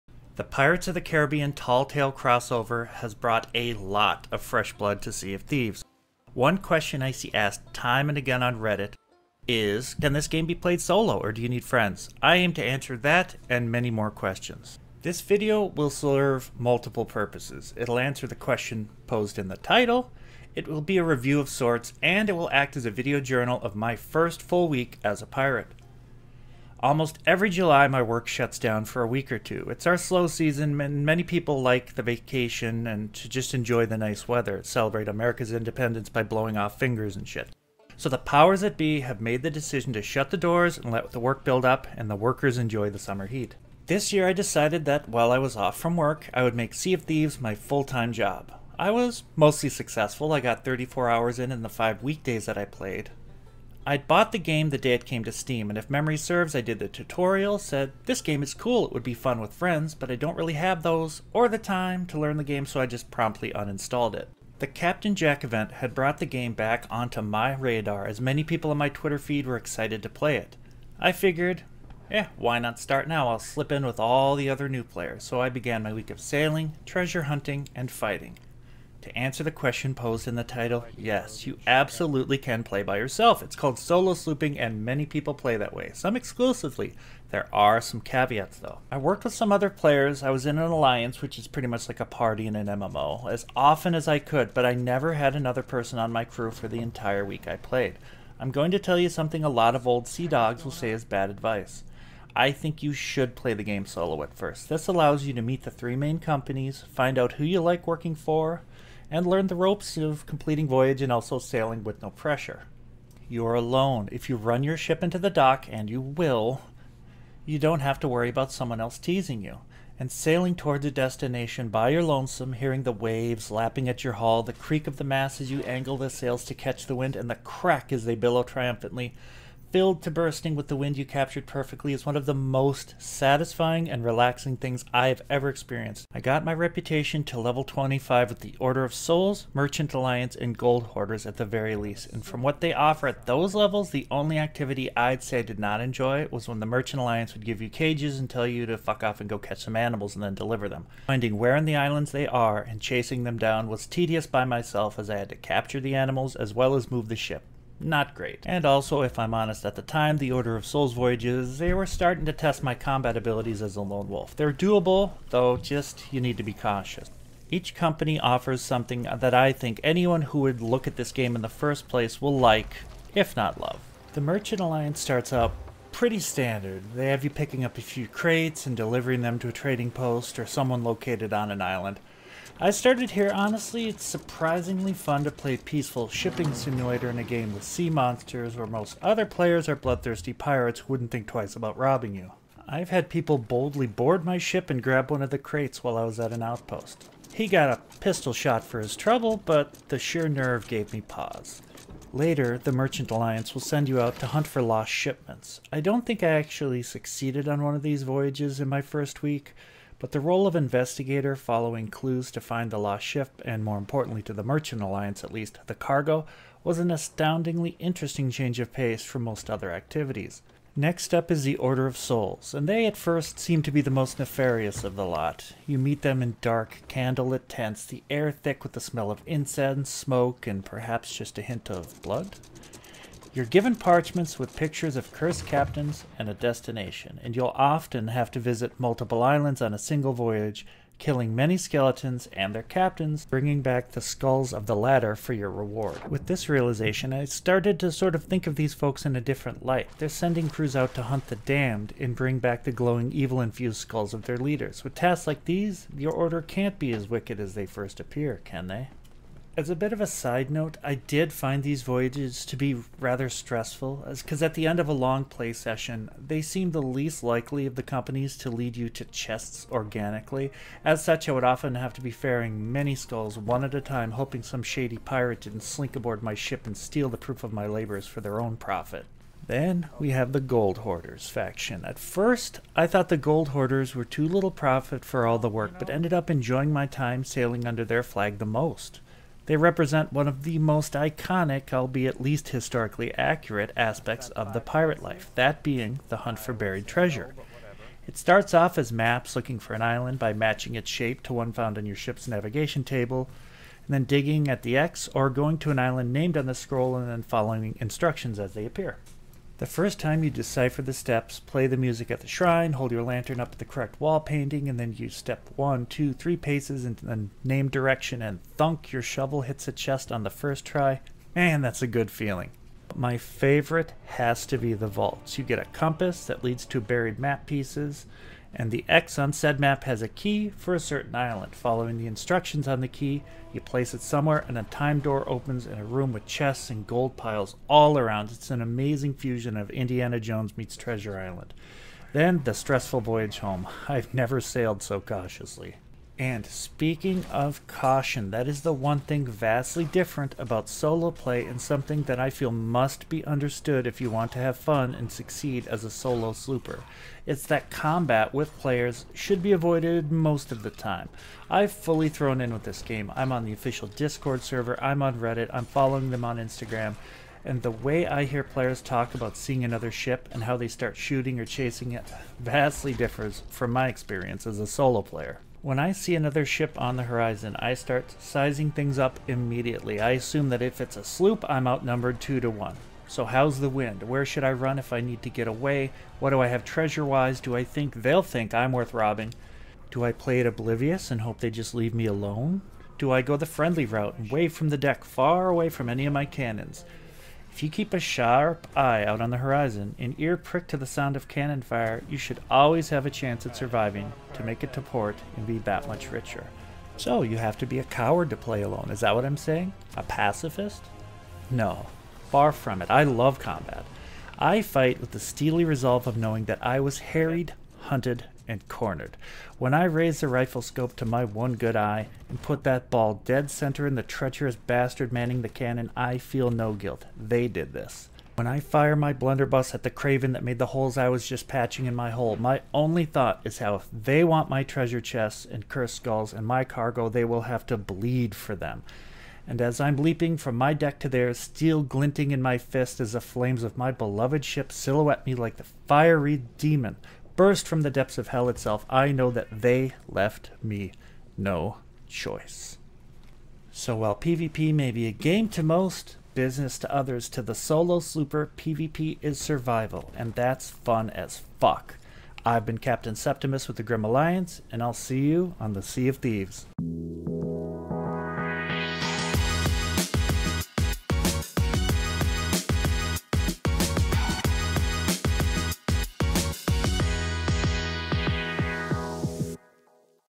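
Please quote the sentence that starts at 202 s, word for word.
Later, the Merchant Alliance will send you out to hunt for lost shipments.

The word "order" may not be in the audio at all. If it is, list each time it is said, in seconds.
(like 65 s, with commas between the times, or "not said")
138 s, 160 s, 221 s, 256 s.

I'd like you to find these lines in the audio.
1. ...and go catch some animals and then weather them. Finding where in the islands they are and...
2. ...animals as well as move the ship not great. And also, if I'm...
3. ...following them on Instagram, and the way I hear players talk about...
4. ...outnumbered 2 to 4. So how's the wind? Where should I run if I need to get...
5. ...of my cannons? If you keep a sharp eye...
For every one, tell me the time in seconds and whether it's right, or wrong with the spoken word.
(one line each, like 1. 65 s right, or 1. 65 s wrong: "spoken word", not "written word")
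1. 149 s wrong: "deliver", not "weather"
2. 155 s right
3. 365 s right
4. 381 s wrong: "1", not "4"
5. 396 s right.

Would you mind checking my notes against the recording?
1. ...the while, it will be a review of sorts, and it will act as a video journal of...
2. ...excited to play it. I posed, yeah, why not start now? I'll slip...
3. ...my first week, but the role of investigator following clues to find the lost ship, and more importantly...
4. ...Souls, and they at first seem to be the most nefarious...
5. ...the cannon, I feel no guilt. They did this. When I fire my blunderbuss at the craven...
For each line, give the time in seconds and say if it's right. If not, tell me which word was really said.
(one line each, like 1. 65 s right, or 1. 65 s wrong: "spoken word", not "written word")
1. 19 s wrong: "title", not "while"
2. 69 s wrong: "figured", not "posed"
3. 208 s right
4. 221 s right
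5. 425 s right.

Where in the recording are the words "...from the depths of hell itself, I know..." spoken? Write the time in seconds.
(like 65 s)
447 s.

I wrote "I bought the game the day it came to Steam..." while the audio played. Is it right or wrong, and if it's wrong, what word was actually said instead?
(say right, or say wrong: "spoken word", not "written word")
right.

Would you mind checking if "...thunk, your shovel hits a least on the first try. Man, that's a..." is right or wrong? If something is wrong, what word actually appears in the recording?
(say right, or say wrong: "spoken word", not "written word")
wrong: "chest", not "least".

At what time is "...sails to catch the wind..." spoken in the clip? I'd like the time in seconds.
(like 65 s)
126 s.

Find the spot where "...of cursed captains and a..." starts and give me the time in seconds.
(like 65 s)
234 s.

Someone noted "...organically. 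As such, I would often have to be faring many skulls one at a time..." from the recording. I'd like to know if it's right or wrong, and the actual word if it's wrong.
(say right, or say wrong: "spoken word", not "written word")
right.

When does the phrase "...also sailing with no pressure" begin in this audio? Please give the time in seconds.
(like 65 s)
111 s.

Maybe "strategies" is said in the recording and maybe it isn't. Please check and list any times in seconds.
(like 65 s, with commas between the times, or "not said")
not said.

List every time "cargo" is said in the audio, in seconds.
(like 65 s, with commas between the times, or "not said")
215 s, 436 s.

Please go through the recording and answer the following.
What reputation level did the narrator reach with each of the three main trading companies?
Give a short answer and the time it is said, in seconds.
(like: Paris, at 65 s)
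25, at 137 s.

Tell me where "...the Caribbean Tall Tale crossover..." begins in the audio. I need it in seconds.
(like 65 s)
0 s.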